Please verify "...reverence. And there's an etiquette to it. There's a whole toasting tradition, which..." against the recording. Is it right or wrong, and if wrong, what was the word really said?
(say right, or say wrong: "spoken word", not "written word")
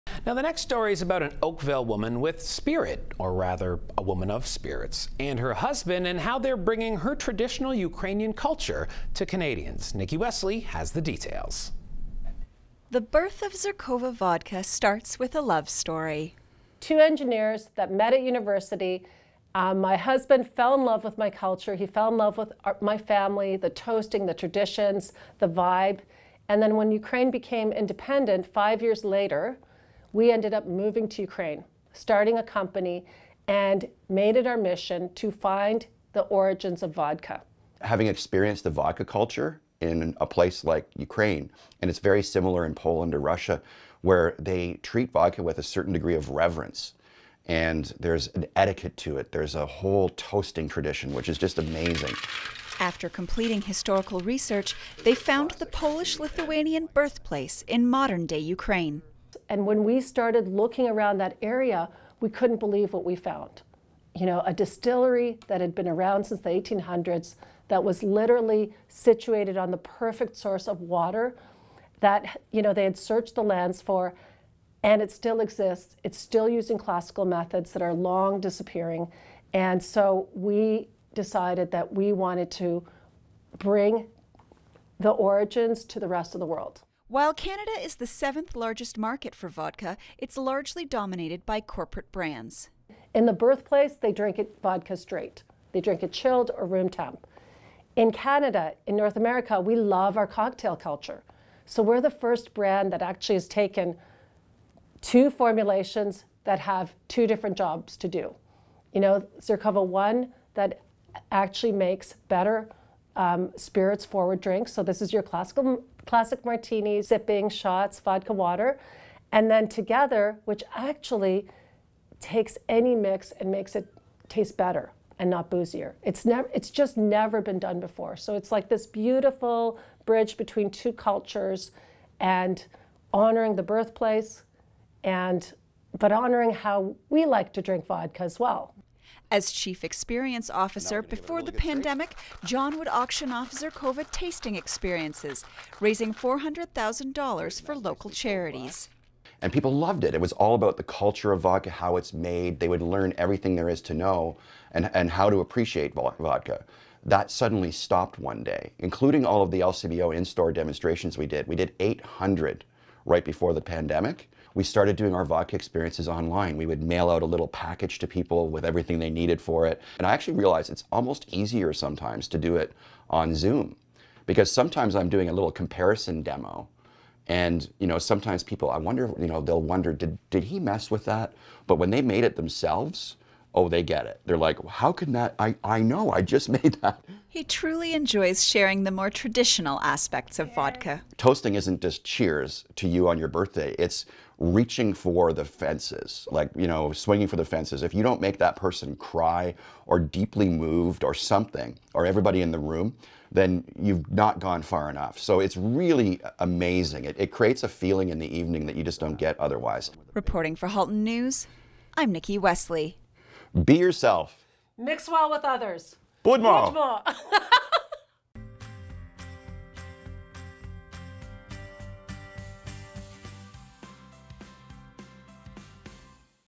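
right.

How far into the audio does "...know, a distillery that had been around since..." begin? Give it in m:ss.
1:04.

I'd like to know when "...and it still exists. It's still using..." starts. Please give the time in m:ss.
1:14.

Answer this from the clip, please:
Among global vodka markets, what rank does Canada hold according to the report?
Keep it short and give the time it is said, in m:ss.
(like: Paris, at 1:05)
7th, at 1:28.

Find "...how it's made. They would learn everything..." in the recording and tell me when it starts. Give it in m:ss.
2:31.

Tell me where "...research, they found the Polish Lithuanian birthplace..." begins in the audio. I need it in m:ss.
0:54.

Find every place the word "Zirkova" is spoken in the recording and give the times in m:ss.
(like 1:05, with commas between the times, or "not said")
0:13, 1:49, 2:23.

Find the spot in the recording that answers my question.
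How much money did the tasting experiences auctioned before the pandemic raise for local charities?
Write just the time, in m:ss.
2:26.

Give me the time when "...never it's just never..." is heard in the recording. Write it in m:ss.
2:06.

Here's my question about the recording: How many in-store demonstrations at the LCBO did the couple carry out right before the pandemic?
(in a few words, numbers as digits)
800.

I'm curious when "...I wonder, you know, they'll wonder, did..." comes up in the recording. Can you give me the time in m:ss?
2:58.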